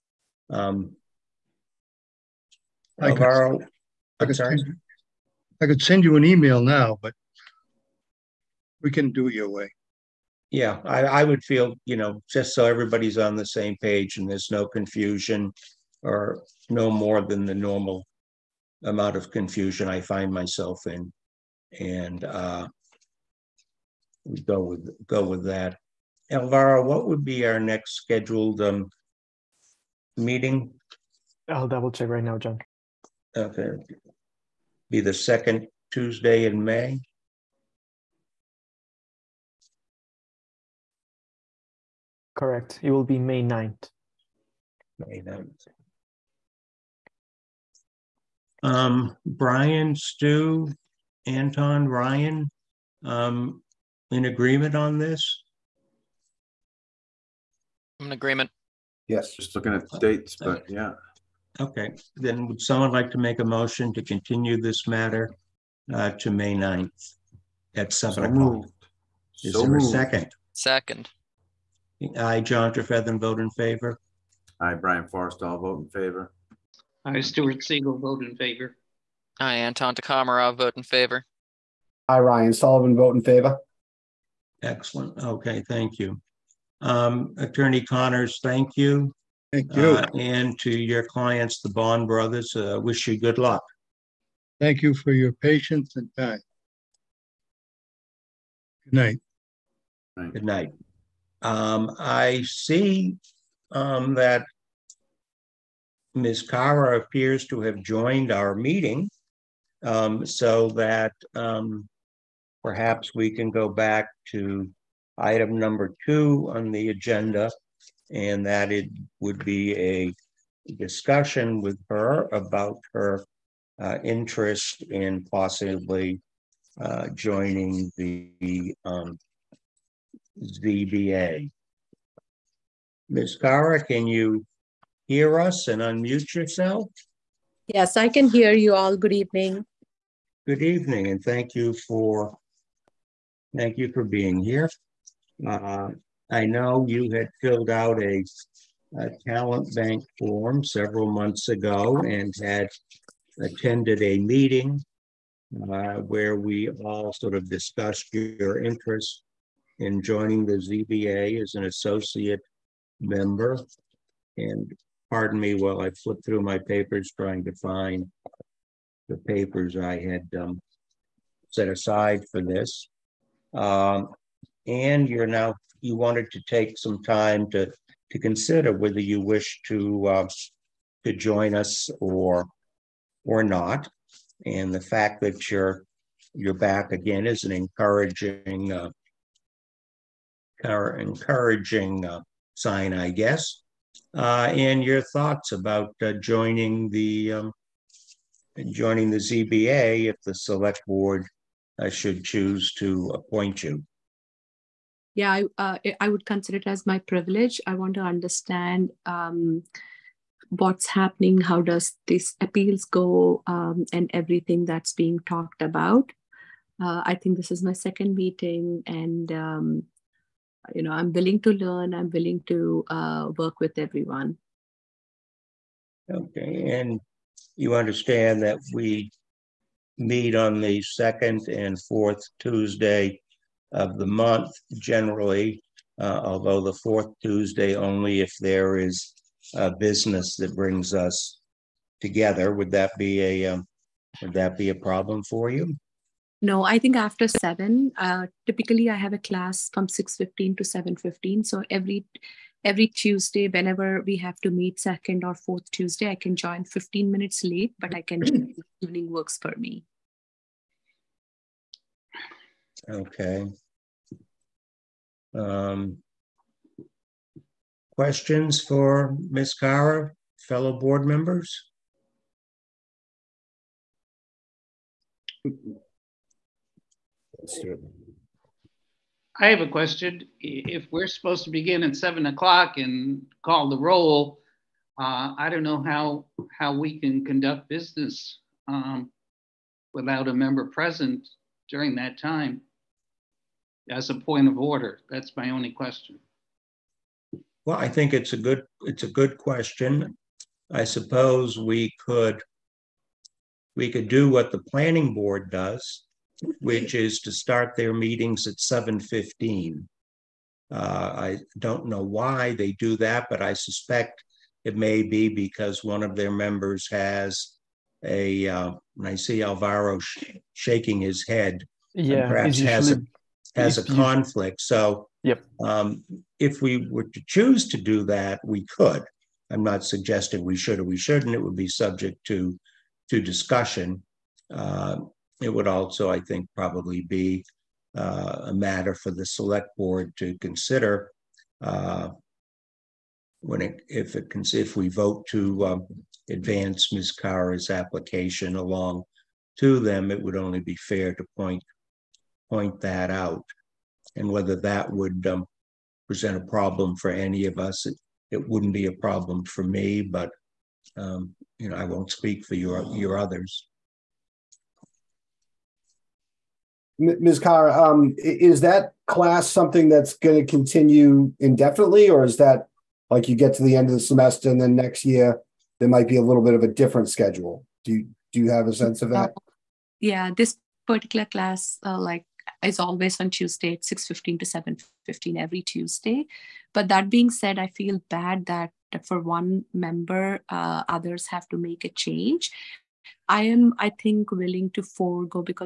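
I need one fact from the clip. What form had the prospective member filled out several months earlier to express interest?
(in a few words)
talent bank form.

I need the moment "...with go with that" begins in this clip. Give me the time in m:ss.
0:24.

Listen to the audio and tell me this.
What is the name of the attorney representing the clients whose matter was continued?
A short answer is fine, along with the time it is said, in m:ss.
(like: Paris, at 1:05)
Attorney Connors, at 1:27.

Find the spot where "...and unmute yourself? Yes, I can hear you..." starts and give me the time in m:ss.
2:15.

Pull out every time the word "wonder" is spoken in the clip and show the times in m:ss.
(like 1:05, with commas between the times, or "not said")
not said.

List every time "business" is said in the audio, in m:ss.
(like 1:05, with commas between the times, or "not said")
3:59, 4:47.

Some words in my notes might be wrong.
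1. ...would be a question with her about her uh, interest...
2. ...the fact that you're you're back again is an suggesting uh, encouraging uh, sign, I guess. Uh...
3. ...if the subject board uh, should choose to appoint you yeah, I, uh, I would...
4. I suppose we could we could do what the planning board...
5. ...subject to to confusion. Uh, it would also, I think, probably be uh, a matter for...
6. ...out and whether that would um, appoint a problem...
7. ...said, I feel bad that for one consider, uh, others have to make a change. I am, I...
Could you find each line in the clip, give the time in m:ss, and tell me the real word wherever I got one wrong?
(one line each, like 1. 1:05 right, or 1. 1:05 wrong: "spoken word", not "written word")
1. 1:59 wrong: "discussion", not "question"
2. 3:04 wrong: "encouraging", not "suggesting"
3. 3:20 wrong: "select", not "subject"
4. 5:00 right
5. 5:31 wrong: "discussion", not "confusion"
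6. 5:53 wrong: "present", not "appoint"
7. 6:27 wrong: "member", not "consider".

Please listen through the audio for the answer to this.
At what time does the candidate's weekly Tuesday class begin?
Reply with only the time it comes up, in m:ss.
4:09.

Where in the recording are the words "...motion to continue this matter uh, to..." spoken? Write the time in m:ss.
1:03.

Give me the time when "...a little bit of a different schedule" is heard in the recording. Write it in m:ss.
6:16.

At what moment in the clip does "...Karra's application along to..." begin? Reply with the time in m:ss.
5:47.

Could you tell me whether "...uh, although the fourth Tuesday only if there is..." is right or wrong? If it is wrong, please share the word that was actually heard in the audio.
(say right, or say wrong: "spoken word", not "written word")
right.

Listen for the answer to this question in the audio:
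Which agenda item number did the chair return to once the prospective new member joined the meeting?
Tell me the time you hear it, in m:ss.
1:55.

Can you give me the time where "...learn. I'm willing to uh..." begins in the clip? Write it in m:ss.
3:41.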